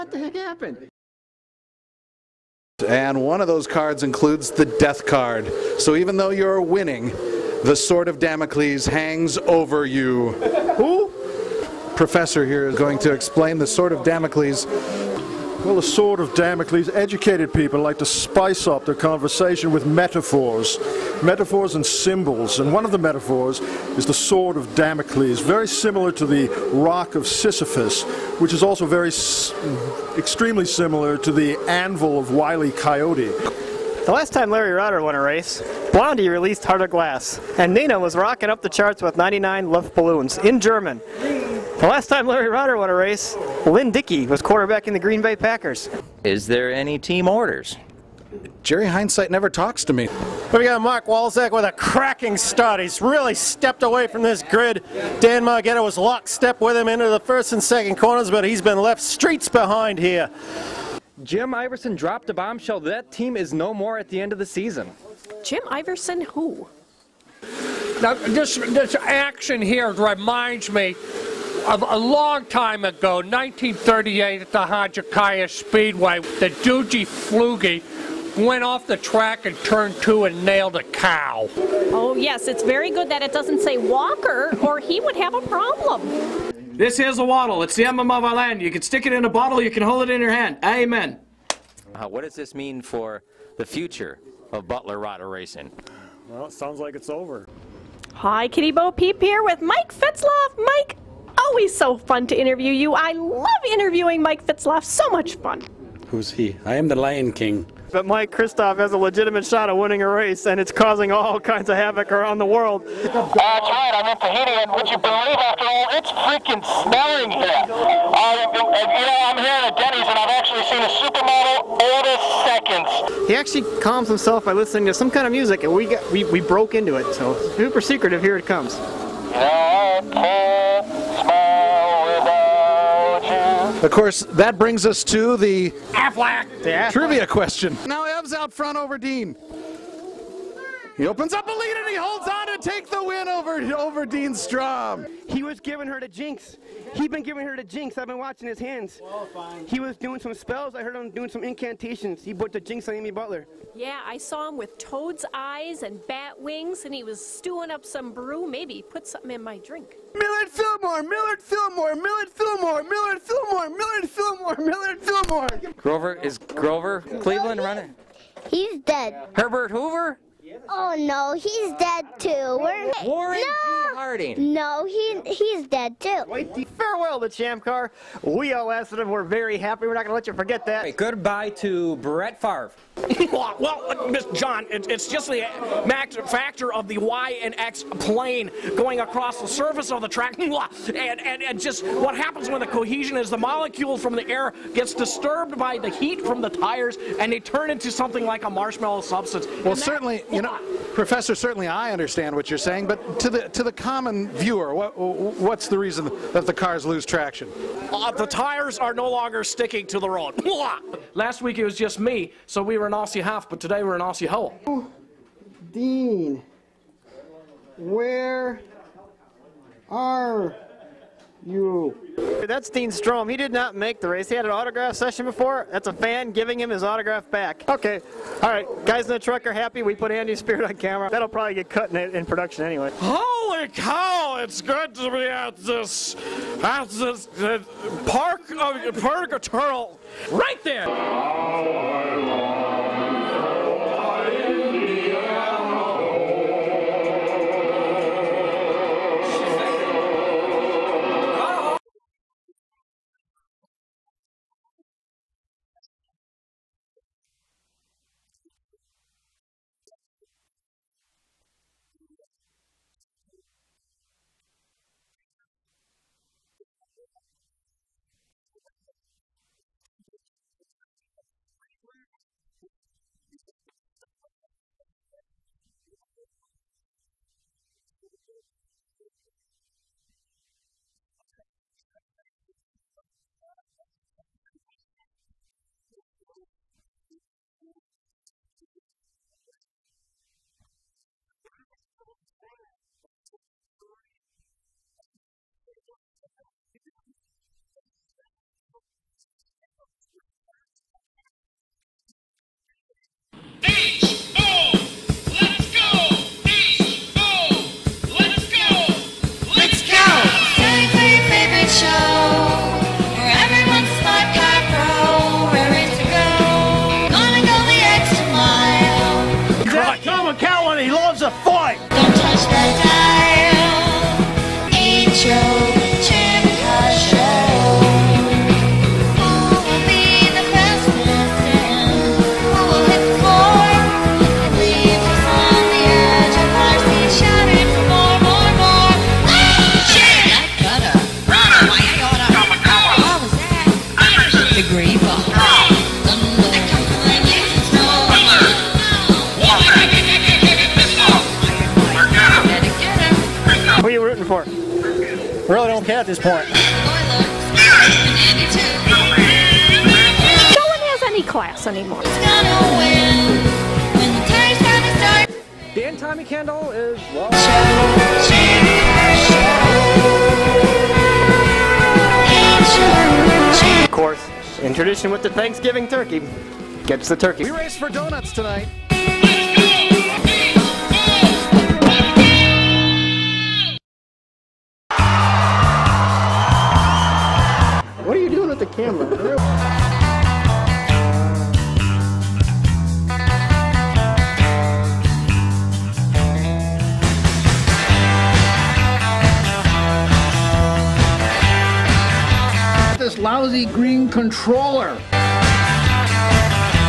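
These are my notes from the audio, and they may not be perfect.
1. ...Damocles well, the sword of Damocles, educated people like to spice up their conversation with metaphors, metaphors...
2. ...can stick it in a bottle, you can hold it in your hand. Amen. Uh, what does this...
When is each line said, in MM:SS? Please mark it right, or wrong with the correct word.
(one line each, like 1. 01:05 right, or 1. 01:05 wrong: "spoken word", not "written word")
1. 00:14 right
2. 01:28 right.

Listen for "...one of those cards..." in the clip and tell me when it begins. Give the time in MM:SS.
00:03.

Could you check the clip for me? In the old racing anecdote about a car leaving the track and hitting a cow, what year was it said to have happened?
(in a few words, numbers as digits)
1938.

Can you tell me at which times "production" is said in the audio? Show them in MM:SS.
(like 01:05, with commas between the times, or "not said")
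03:52.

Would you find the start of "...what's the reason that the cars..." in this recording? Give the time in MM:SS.
03:24.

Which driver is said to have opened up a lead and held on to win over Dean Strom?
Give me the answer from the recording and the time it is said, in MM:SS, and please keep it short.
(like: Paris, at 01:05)
Ev, at 02:18.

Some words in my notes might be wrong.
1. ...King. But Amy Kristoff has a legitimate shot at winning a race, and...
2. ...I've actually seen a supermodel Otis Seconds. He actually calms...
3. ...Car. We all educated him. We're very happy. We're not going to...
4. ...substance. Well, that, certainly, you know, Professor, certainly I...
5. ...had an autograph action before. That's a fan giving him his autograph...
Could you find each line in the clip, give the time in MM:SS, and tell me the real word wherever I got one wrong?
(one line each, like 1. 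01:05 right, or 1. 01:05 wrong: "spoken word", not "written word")
1. 01:47 wrong: "Mike", not "Amy"
2. 02:00 right
3. 02:57 wrong: "asked", not "educated"
4. 03:19 right
5. 03:44 wrong: "session", not "action".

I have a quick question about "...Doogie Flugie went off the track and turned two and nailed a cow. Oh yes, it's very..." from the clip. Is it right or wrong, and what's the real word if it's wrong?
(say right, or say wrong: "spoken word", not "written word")
right.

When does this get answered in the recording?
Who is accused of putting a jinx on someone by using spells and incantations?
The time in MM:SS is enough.
02:32.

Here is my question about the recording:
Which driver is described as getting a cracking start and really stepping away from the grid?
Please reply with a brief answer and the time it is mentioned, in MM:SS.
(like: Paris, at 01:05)
Mark Walzak, at 00:50.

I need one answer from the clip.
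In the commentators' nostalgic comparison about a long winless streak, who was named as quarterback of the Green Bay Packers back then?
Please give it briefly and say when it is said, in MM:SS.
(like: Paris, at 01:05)
Lynn Dickey, at 00:43.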